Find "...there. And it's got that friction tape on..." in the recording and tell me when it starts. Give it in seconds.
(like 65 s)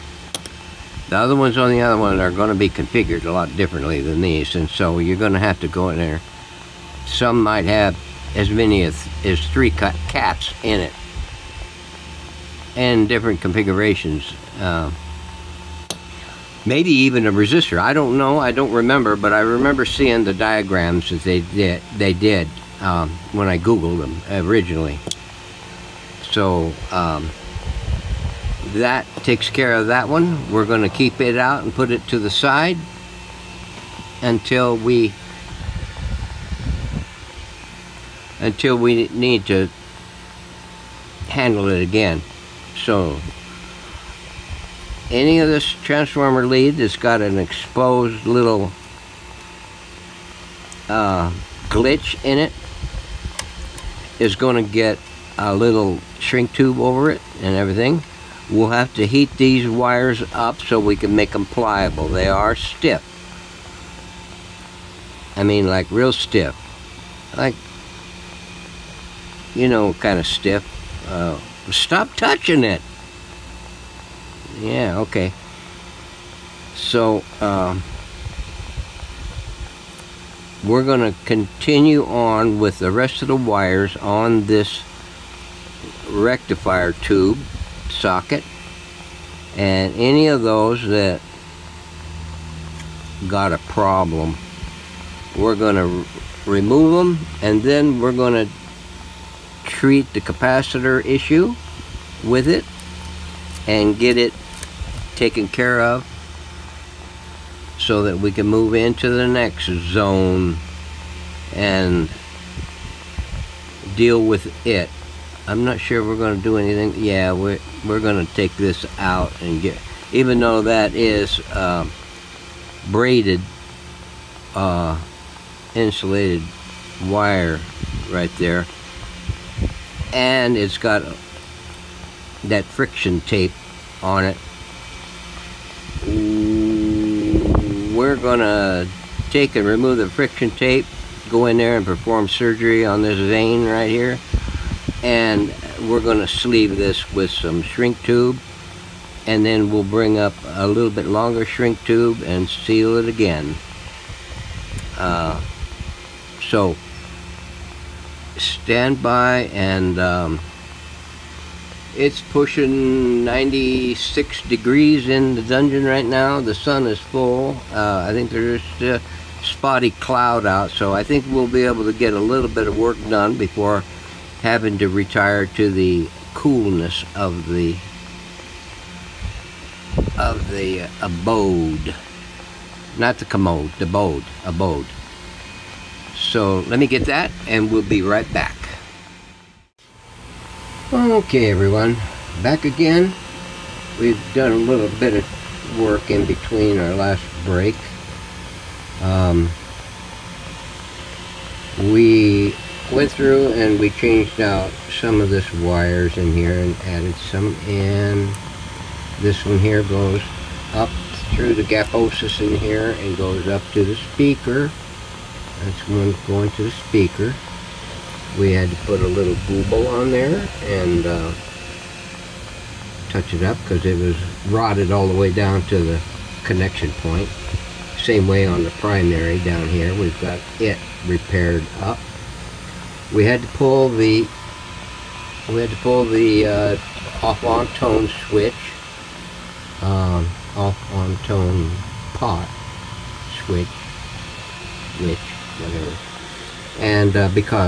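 128 s.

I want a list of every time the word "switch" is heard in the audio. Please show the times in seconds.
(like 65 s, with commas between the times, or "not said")
238 s, 243 s.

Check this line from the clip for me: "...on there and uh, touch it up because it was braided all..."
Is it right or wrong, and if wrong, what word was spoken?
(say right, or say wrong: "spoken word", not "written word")
wrong: "rotted", not "braided".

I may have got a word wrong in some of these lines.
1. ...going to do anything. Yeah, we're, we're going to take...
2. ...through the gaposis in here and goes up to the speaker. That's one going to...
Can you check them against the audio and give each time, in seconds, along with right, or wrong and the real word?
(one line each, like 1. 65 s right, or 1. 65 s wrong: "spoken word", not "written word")
1. 116 s right
2. 211 s right.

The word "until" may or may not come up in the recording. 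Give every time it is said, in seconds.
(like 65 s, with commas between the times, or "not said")
34 s, 38 s.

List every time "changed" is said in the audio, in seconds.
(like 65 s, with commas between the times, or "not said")
203 s.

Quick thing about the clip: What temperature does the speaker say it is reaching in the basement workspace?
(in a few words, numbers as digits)
96 degrees.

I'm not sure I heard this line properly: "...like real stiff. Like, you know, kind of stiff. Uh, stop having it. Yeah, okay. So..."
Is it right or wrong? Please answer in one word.
wrong.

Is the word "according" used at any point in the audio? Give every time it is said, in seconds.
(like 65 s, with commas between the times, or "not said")
not said.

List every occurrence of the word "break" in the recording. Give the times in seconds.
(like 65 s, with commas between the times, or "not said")
197 s.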